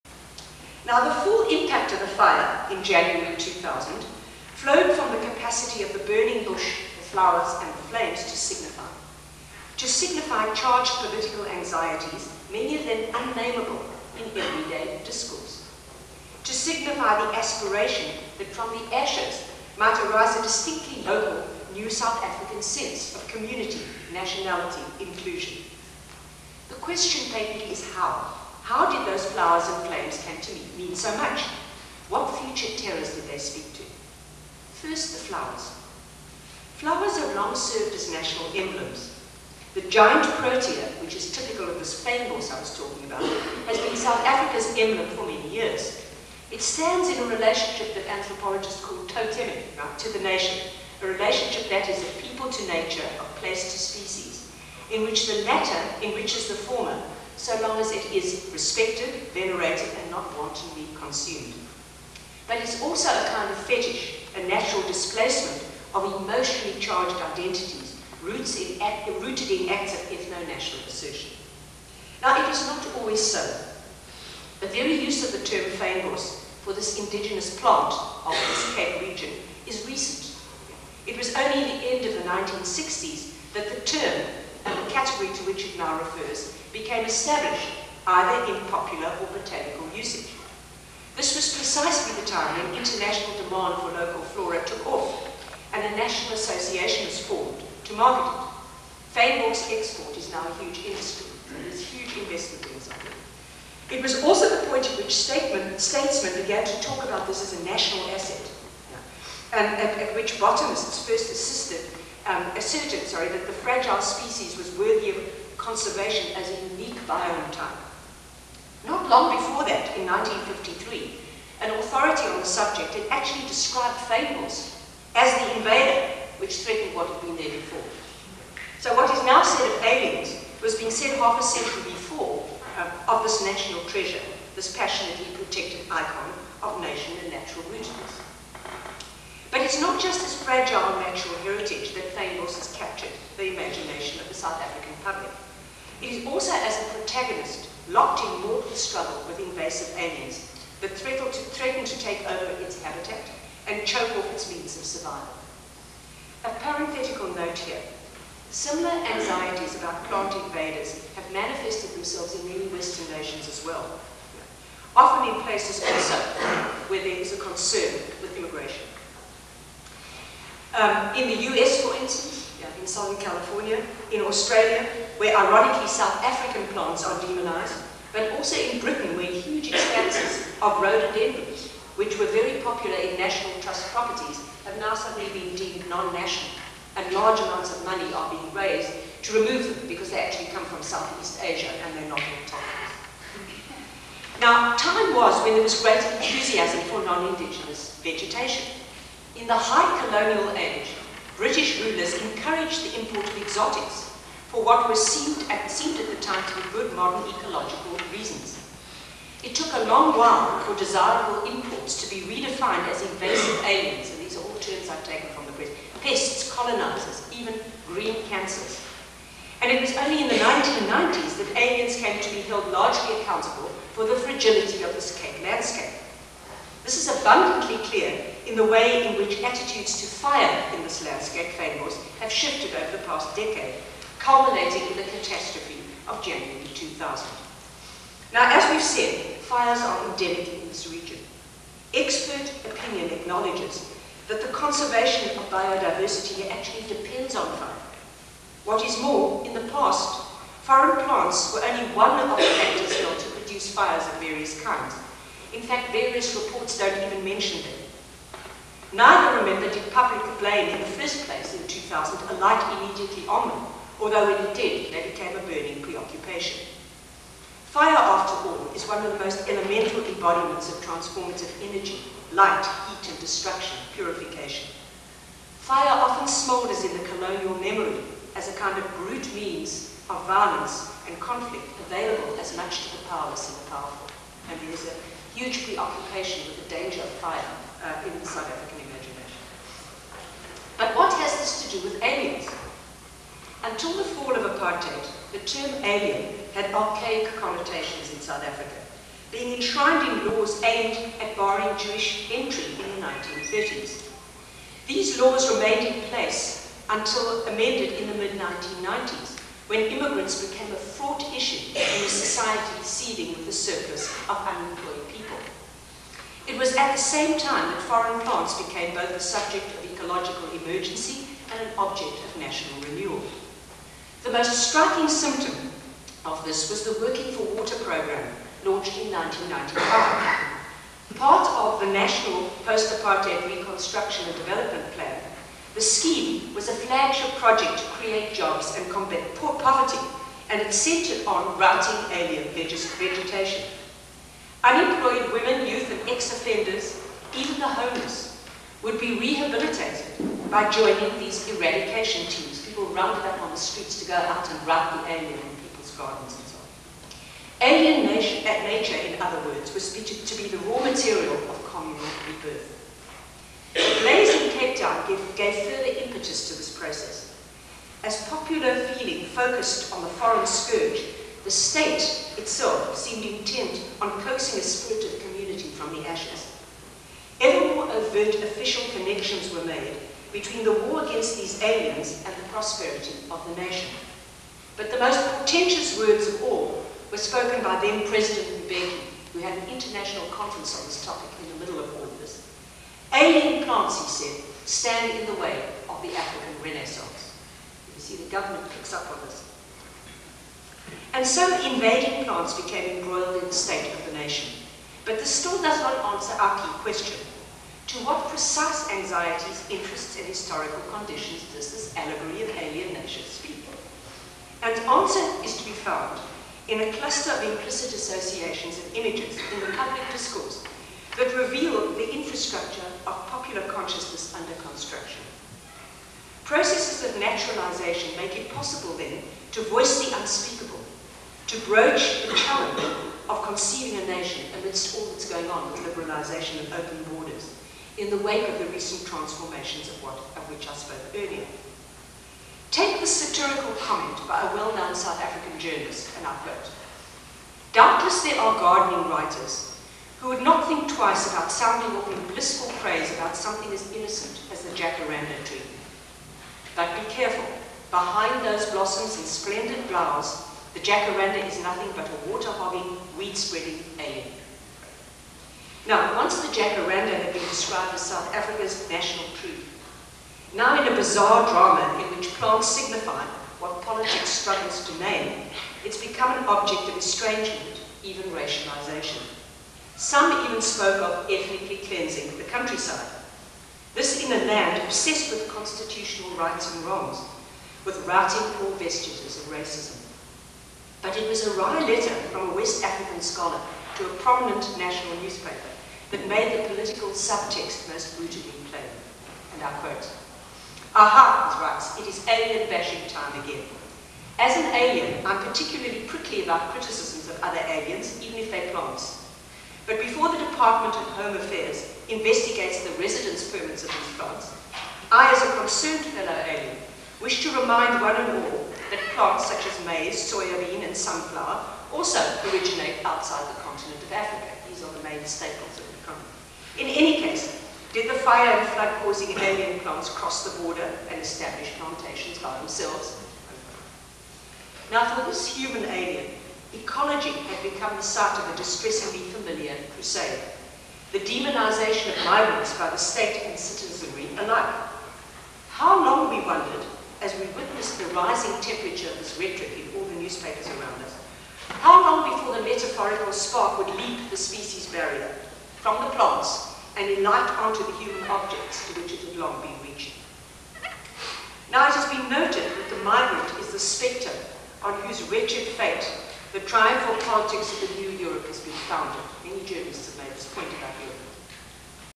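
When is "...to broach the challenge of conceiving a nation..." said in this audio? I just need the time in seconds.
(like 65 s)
431 s.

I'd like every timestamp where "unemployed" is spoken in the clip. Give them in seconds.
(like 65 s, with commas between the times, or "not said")
314 s, 344 s.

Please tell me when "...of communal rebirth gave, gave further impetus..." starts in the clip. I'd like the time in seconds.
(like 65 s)
361 s.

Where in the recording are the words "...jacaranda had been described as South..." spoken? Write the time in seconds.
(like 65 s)
466 s.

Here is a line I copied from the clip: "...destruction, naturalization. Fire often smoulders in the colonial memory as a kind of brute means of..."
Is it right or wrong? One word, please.
wrong.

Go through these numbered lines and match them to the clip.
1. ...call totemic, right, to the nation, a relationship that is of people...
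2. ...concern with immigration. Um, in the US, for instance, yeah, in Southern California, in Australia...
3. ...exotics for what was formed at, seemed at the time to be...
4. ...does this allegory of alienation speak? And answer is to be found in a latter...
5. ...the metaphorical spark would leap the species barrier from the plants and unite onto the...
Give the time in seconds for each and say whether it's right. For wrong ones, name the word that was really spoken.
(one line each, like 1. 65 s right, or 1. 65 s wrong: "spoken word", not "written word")
1. 48 s right
2. 167 s right
3. 203 s wrong: "seemed", not "formed"
4. 411 s wrong: "cluster", not "latter"
5. 552 s right.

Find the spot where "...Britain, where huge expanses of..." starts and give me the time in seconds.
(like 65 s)
178 s.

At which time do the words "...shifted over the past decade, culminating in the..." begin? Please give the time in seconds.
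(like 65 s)
232 s.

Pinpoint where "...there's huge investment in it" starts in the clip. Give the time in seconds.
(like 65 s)
101 s.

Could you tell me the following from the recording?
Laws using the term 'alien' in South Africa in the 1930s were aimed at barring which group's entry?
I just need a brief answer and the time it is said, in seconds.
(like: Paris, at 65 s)
Jewish, at 301 s.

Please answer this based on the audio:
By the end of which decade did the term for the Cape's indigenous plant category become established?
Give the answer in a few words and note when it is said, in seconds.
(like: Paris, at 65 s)
1960s, at 82 s.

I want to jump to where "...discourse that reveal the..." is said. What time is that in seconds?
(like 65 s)
420 s.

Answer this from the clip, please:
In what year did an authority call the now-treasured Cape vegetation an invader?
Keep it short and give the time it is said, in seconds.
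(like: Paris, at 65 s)
1953, at 120 s.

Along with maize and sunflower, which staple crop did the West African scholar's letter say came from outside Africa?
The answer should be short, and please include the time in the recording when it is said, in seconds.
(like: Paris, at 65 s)
Soybean, at 520 s.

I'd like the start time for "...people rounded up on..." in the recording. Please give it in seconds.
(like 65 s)
352 s.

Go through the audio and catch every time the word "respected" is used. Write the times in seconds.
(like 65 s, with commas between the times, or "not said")
58 s.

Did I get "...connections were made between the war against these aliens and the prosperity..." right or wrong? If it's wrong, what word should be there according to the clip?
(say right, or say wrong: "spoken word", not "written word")
right.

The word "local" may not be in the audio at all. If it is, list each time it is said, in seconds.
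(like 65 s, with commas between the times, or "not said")
21 s, 93 s.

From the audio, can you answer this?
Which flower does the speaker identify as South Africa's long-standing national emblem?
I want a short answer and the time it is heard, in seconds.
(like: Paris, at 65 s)
Giant protea, at 39 s.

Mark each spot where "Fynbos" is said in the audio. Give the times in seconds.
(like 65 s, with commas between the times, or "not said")
75 s, 99 s, 124 s, 142 s.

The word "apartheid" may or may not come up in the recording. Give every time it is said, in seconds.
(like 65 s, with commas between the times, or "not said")
294 s, 332 s.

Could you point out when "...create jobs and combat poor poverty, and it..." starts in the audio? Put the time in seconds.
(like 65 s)
337 s.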